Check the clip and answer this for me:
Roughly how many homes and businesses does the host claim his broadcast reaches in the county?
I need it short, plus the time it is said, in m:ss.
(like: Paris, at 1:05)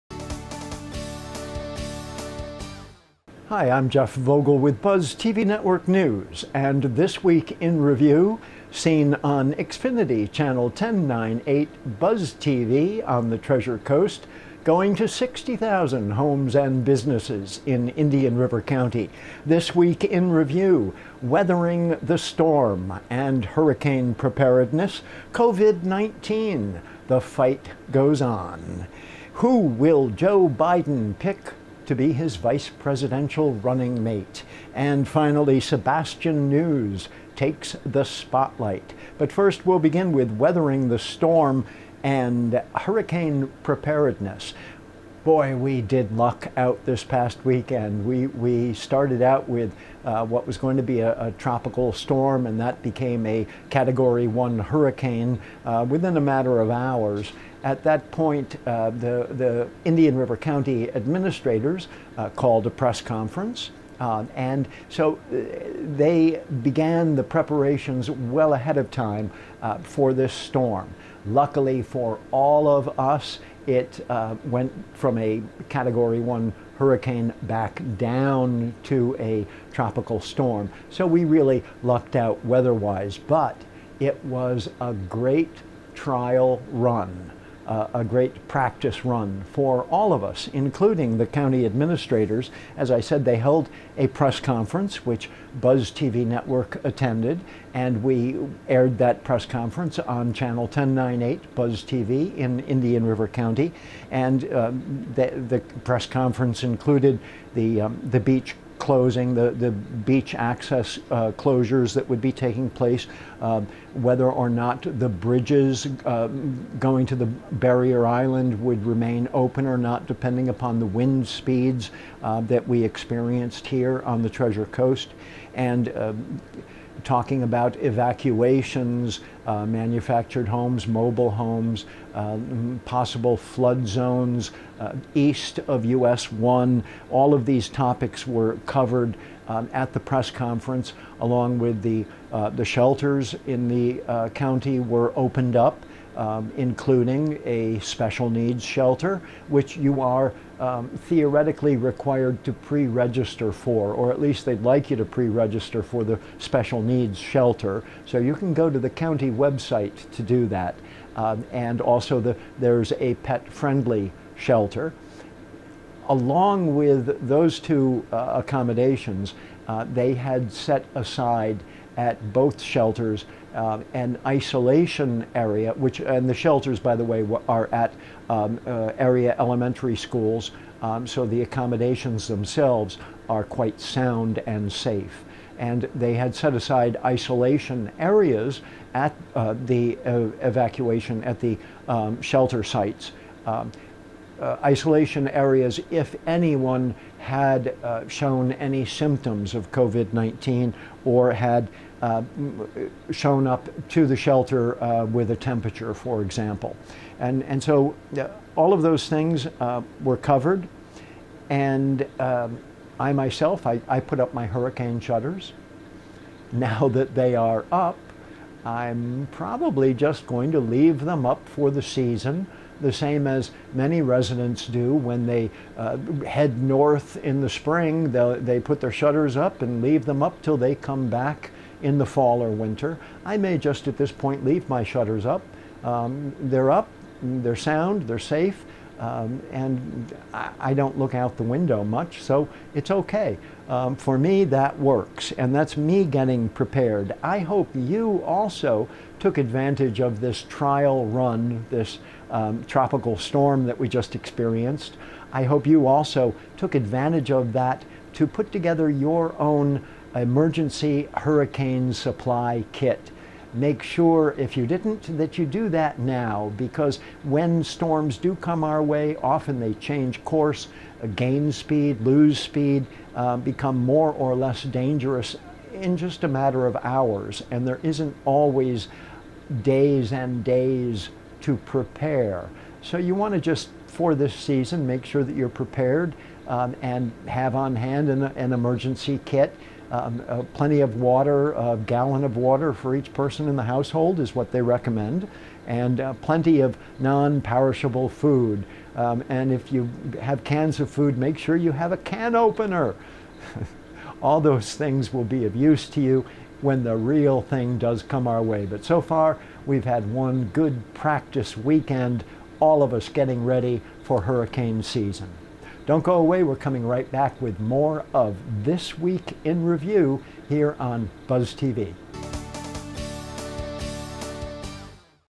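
60,000, at 0:15.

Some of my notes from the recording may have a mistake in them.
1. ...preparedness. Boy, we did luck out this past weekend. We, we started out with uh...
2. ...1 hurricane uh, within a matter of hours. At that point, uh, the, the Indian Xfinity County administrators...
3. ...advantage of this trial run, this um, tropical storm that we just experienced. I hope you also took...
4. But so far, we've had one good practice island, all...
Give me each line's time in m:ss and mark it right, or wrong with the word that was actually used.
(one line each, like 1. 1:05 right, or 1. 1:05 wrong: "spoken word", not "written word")
1. 0:43 right
2. 0:54 wrong: "River", not "Xfinity"
3. 4:09 right
4. 5:08 wrong: "weekend", not "island".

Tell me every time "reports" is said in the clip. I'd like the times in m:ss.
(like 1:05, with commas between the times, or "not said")
not said.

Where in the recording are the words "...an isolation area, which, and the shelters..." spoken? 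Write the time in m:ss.
2:53.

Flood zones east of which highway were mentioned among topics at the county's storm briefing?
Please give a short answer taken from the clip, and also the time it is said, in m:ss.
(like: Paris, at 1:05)
US 1, at 2:15.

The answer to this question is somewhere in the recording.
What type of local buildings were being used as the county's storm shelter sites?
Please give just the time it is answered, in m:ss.
2:59.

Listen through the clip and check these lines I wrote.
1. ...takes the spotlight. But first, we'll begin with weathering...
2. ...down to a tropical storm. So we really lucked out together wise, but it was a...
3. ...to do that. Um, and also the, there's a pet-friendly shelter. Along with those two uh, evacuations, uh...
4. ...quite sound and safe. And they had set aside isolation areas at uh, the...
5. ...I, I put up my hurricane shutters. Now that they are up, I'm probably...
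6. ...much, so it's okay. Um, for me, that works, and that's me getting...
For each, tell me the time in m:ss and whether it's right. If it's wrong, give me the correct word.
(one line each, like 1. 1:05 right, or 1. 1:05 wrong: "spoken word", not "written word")
1. 0:37 right
2. 1:17 wrong: "weather", not "together"
3. 2:40 wrong: "accommodations", not "evacuations"
4. 3:03 right
5. 3:33 right
6. 4:01 right.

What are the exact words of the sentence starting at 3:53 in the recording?
I may just at this point leave my shutters up.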